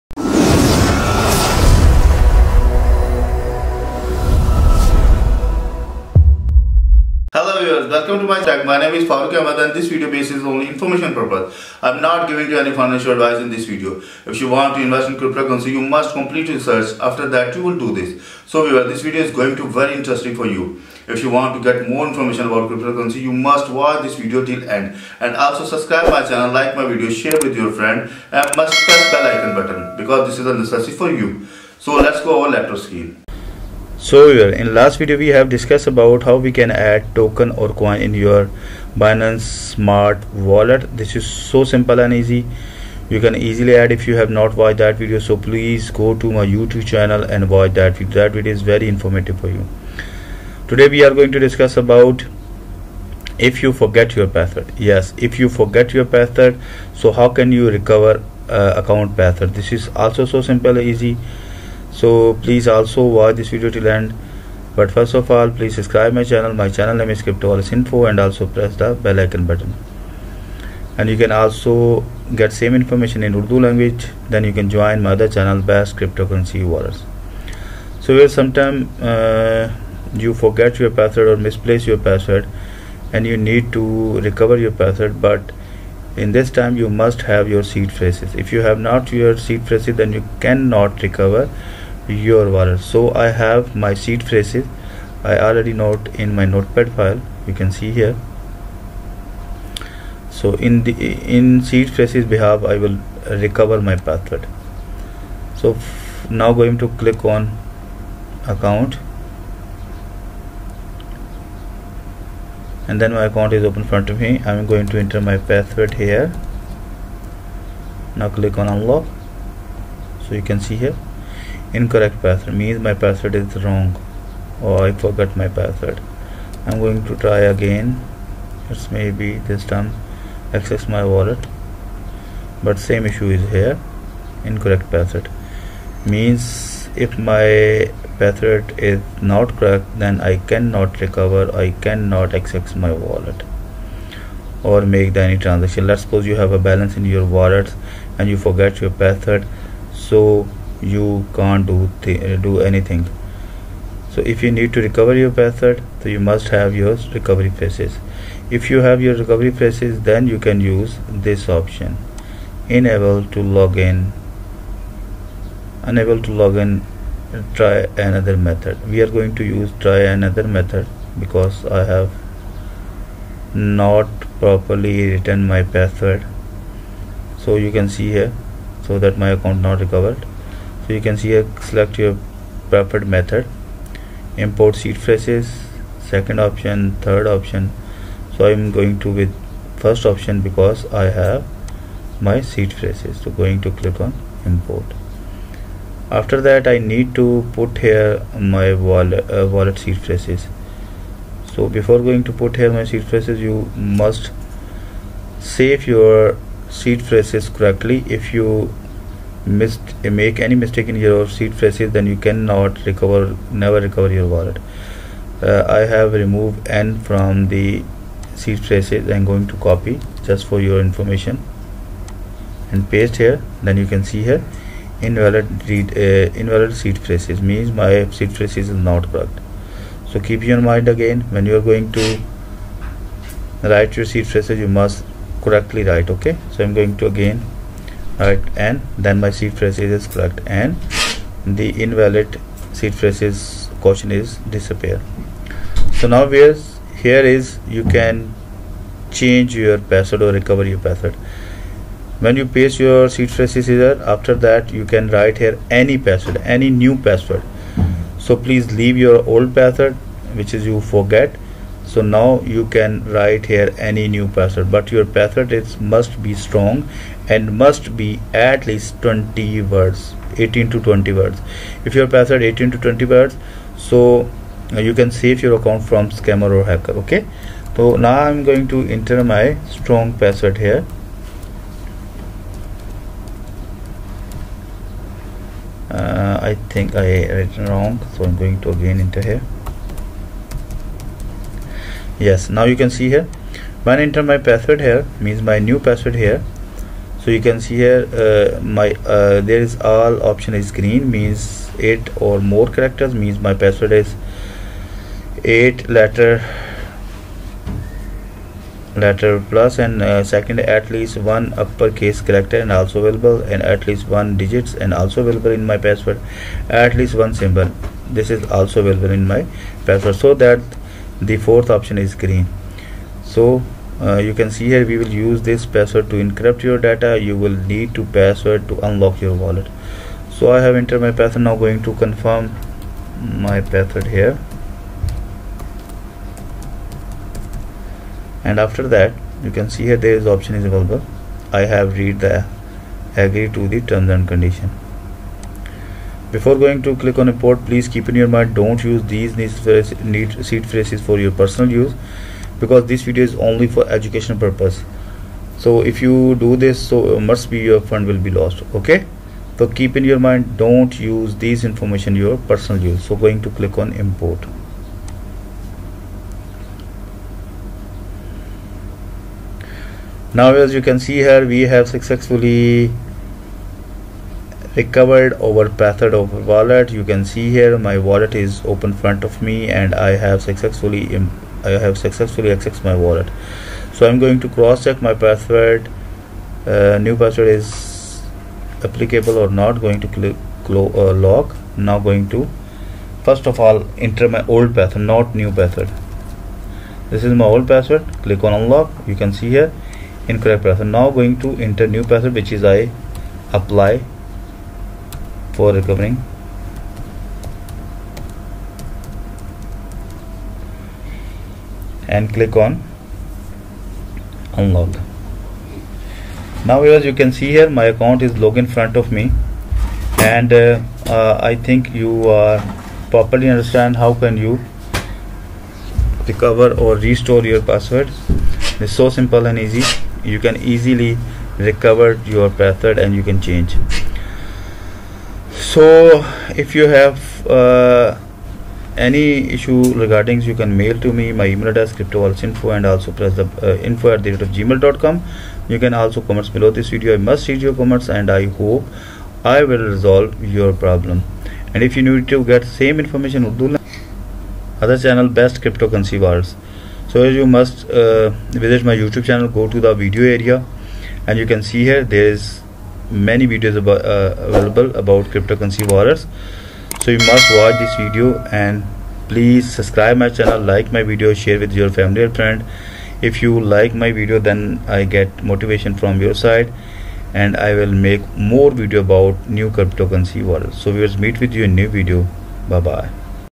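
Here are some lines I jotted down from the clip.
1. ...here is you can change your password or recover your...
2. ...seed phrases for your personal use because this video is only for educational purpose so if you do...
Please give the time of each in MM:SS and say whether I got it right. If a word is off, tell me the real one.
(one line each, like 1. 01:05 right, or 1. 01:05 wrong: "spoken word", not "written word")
1. 04:06 right
2. 05:50 right.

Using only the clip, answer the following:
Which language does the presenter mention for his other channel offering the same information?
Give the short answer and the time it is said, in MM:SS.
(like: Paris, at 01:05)
Urdu, at 01:13.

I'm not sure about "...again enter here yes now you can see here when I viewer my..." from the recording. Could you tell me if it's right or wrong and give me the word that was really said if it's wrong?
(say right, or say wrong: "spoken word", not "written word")
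wrong: "enter", not "viewer".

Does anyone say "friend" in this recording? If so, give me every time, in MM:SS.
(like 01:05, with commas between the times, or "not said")
00:27, 07:52.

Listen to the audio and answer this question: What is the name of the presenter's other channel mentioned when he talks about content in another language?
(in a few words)
Best Cryptocurrency Wallets.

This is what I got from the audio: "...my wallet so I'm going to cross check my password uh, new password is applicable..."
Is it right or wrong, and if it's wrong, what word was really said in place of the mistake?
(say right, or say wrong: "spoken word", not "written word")
right.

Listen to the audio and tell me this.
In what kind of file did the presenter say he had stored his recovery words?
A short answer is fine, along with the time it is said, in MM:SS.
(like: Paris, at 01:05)
Notepad file, at 01:36.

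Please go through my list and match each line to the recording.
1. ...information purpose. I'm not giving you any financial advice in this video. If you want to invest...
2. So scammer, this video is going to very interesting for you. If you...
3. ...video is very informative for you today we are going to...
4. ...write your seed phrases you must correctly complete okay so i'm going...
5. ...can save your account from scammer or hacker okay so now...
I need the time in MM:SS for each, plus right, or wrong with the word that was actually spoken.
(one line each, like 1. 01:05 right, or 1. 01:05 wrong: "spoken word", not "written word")
1. 00:10 right
2. 00:18 wrong: "viewer", not "scammer"
3. 00:48 right
4. 03:53 wrong: "write", not "complete"
5. 04:34 right.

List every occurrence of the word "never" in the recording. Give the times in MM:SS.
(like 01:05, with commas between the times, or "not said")
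03:33.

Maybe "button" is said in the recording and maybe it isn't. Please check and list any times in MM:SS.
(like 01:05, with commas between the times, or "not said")
00:29, 01:09.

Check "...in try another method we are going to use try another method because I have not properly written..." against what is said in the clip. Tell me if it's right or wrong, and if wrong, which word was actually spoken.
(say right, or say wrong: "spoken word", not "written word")
right.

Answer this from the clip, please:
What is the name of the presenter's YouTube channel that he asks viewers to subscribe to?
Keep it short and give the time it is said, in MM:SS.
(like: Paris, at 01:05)
Crypto Info, at 01:07.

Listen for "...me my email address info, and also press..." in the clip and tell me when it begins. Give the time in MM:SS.
07:21.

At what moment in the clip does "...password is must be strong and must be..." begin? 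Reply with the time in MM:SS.
04:25.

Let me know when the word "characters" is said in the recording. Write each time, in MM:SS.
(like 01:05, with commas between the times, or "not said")
05:02, 05:12.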